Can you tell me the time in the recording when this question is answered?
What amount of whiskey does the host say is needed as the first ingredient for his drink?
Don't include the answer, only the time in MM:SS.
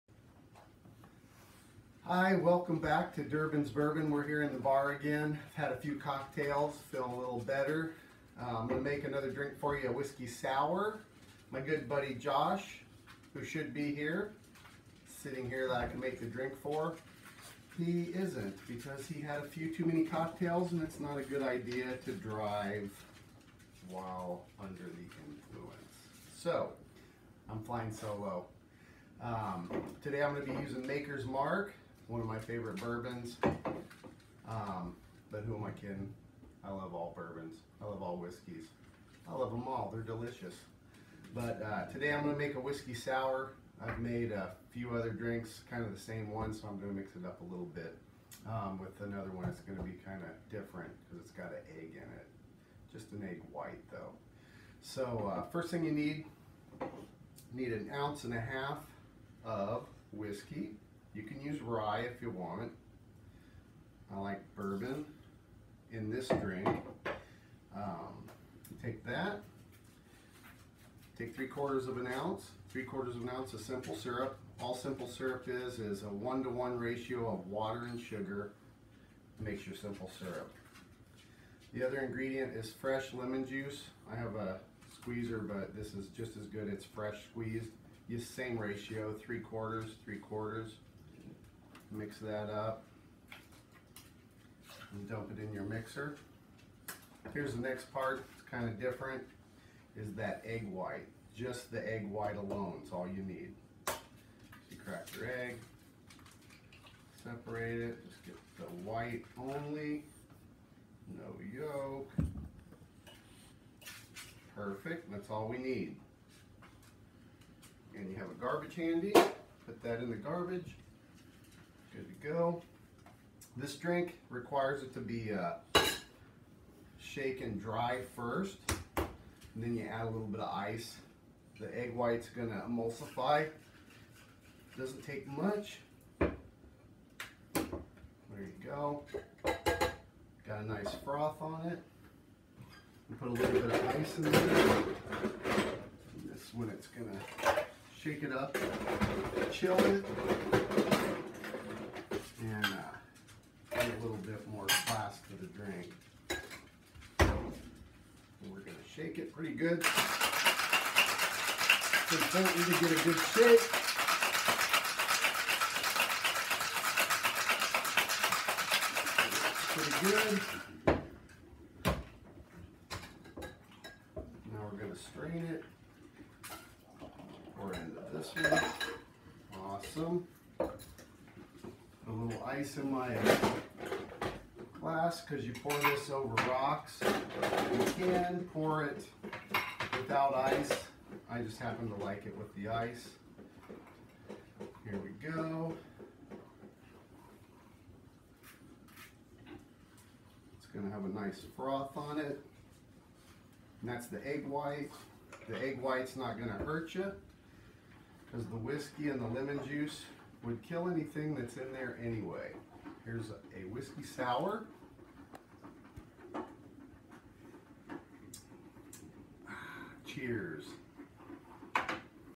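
00:57.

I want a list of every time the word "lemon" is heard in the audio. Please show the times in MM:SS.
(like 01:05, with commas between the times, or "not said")
01:23, 03:29.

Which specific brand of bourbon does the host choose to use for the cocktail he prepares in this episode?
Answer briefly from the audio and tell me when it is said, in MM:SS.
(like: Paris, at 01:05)
Maker's Mark, at 00:30.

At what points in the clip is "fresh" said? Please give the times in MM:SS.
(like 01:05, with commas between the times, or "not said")
01:22, 01:26.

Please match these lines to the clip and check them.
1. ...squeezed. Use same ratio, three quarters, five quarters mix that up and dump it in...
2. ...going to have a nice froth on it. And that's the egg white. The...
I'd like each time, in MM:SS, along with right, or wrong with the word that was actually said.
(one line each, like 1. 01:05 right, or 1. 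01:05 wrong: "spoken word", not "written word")
1. 01:27 wrong: "three", not "five"
2. 03:20 right.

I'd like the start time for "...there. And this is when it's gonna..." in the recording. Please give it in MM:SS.
02:24.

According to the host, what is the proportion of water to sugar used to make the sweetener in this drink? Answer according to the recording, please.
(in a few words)
1 to 1.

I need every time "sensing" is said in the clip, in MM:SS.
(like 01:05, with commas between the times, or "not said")
not said.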